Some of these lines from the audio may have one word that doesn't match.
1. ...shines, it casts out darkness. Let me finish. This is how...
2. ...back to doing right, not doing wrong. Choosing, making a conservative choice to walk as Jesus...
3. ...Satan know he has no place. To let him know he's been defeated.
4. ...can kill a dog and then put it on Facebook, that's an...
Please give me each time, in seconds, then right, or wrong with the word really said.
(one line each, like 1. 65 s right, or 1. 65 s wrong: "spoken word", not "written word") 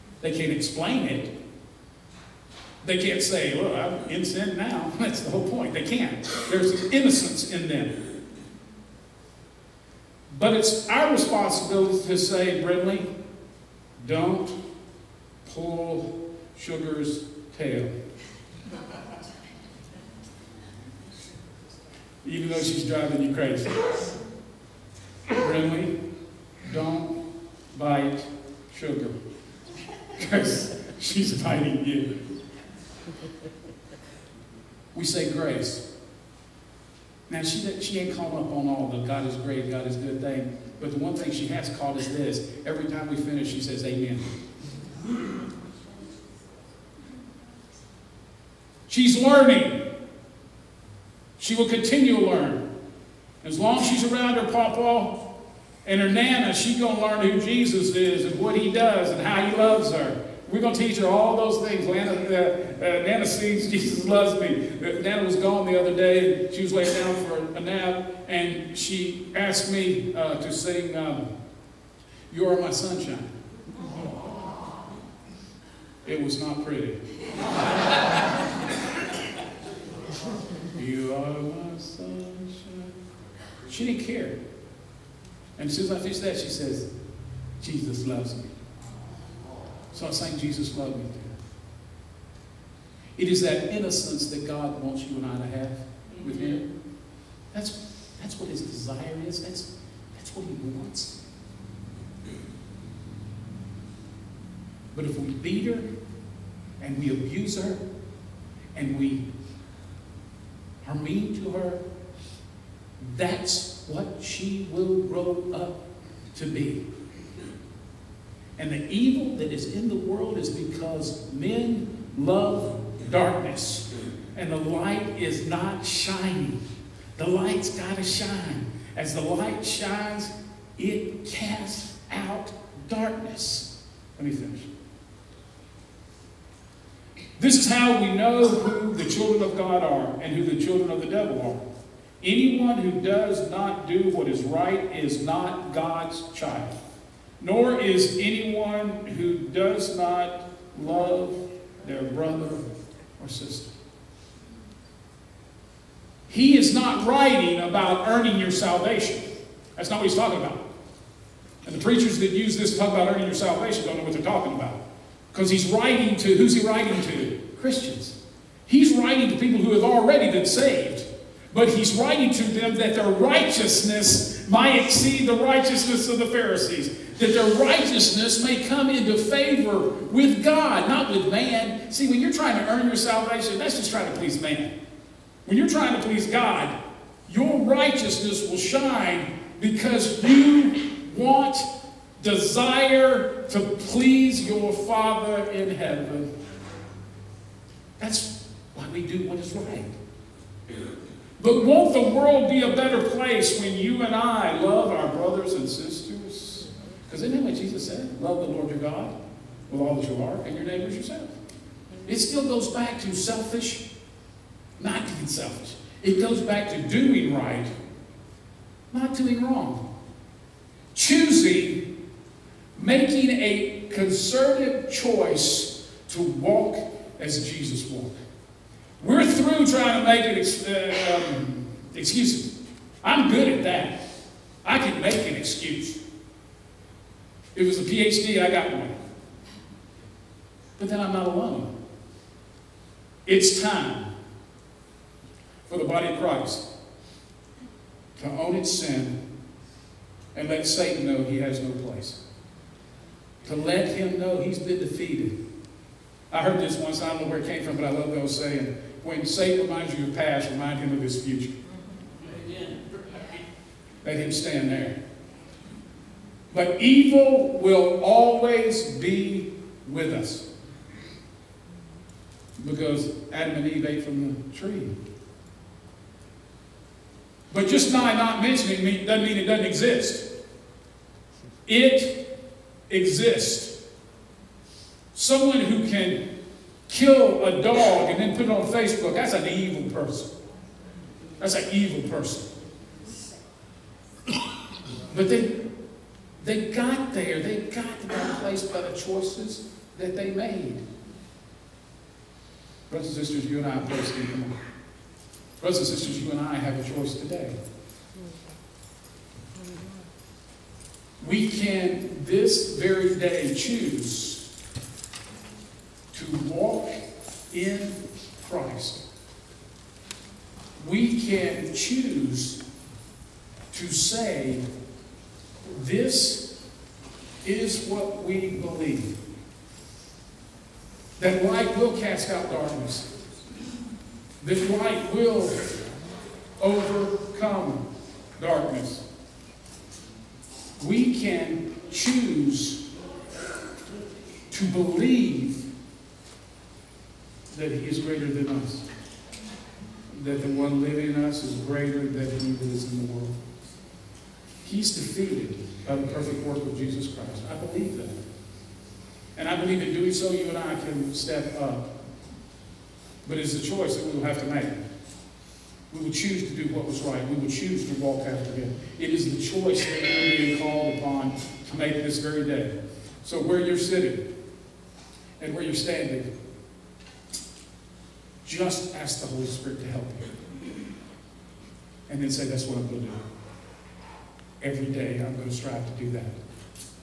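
1. 129 s right
2. 216 s right
3. 250 s right
4. 285 s right.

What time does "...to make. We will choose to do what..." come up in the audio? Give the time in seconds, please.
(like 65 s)
364 s.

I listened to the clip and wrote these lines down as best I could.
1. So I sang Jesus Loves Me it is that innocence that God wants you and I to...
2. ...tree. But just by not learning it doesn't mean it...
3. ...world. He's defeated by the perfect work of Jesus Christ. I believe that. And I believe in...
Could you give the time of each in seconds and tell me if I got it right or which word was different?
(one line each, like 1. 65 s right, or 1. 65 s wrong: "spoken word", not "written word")
1. 89 s right
2. 274 s wrong: "mentioning", not "learning"
3. 353 s right.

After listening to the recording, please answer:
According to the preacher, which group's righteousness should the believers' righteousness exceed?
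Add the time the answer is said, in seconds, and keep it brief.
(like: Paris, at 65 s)
The Pharisees, at 176 s.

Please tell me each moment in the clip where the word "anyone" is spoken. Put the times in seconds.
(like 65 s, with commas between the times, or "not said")
142 s, 148 s.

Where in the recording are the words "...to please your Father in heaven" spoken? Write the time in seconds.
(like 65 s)
193 s.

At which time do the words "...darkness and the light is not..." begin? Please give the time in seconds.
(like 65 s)
123 s.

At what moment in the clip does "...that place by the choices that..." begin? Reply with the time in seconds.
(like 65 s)
298 s.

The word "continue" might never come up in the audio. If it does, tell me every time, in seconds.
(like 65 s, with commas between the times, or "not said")
51 s.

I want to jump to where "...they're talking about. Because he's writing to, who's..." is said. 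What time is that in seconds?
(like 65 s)
164 s.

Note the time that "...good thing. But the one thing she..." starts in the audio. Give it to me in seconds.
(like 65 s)
39 s.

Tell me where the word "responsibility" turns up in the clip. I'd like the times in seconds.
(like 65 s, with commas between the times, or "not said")
11 s.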